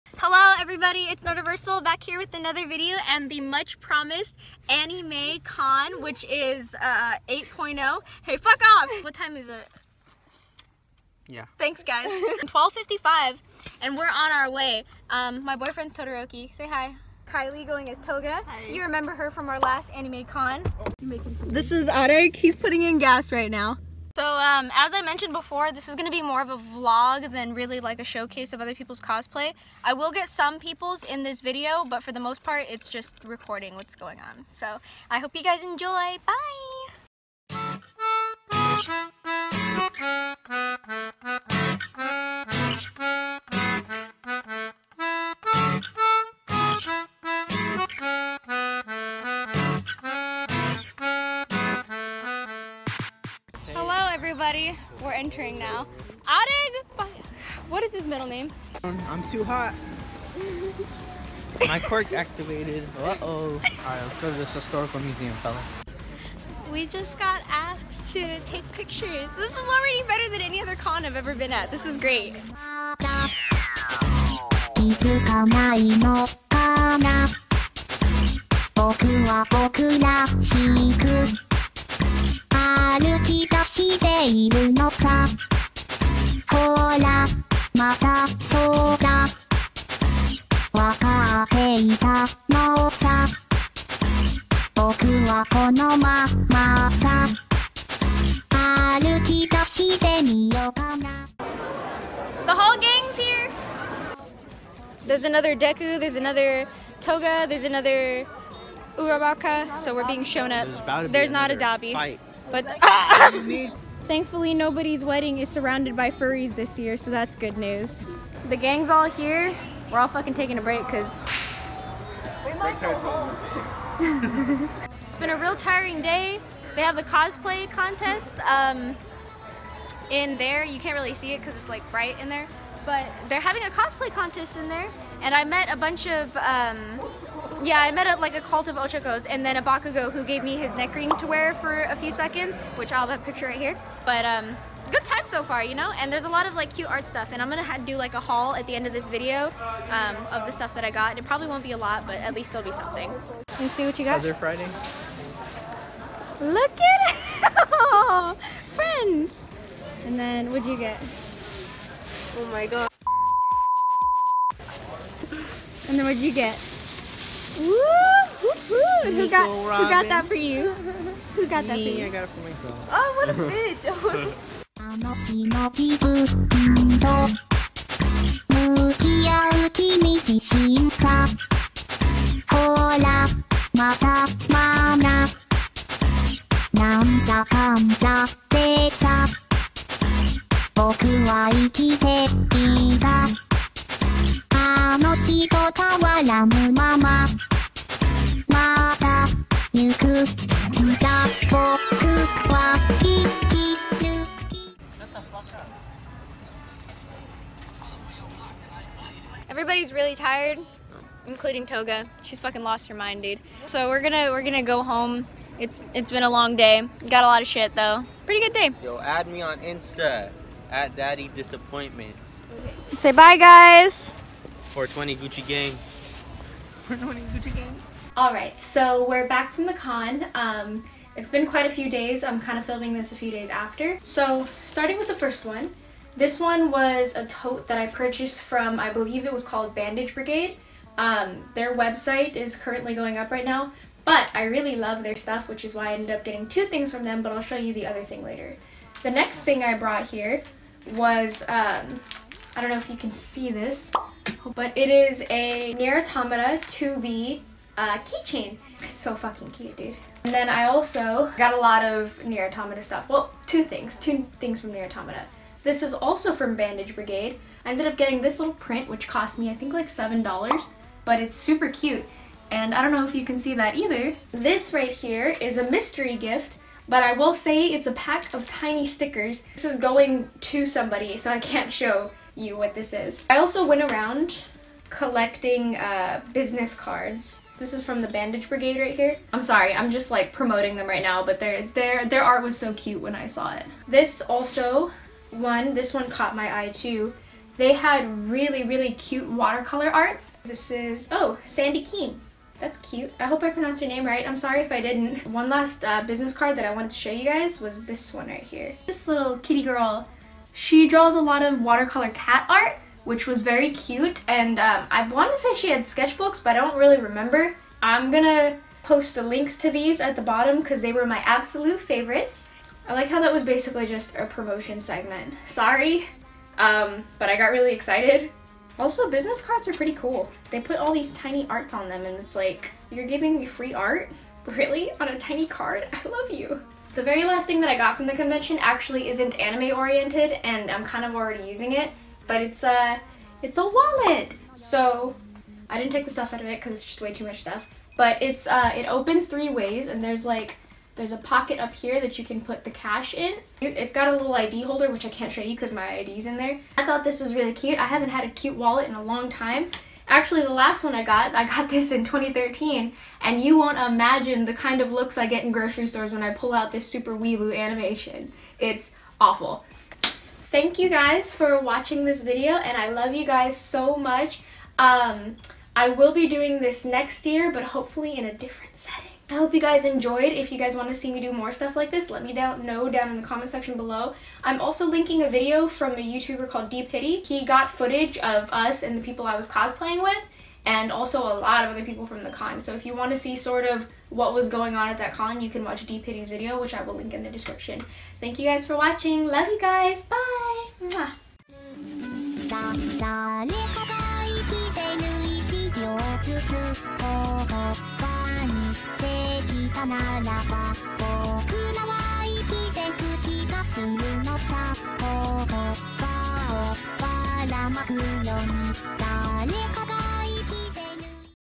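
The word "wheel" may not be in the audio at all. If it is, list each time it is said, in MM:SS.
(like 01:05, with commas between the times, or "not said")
not said.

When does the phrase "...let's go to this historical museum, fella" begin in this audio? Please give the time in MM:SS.
01:04.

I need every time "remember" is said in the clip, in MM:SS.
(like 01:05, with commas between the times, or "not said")
00:18, 05:17.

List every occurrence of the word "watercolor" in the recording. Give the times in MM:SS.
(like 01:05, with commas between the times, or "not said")
04:59, 05:11.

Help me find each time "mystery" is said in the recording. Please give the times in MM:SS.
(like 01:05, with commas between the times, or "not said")
04:35.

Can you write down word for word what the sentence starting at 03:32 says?
She's fucking lost her mind, dude.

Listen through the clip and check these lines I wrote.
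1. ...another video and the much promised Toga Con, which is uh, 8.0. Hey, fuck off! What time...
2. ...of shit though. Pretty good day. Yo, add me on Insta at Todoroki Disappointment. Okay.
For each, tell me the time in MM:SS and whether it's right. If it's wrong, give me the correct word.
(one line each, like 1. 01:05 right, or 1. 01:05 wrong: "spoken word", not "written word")
1. 00:02 wrong: "Anime", not "Toga"
2. 03:37 wrong: "Daddy", not "Todoroki".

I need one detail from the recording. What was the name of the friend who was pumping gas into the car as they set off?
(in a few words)
Arek.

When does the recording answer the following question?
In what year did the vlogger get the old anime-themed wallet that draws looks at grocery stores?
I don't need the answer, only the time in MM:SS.
06:02.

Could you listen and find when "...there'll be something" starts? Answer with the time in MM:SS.
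02:32.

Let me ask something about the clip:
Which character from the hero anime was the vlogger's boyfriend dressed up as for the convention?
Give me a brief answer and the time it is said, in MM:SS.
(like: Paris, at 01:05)
Todoroki, at 00:15.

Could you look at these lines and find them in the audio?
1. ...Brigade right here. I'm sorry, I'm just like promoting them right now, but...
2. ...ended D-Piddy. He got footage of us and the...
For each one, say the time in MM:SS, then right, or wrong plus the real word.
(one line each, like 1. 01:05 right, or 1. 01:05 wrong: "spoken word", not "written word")
1. 04:48 right
2. 06:26 wrong: "called", not "ended".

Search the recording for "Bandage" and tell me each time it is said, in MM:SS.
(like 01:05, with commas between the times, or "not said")
03:59, 04:26, 04:48.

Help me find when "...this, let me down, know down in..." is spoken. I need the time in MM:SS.
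06:21.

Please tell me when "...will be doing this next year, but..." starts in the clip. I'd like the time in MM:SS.
06:15.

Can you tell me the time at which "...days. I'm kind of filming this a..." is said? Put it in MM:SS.
03:51.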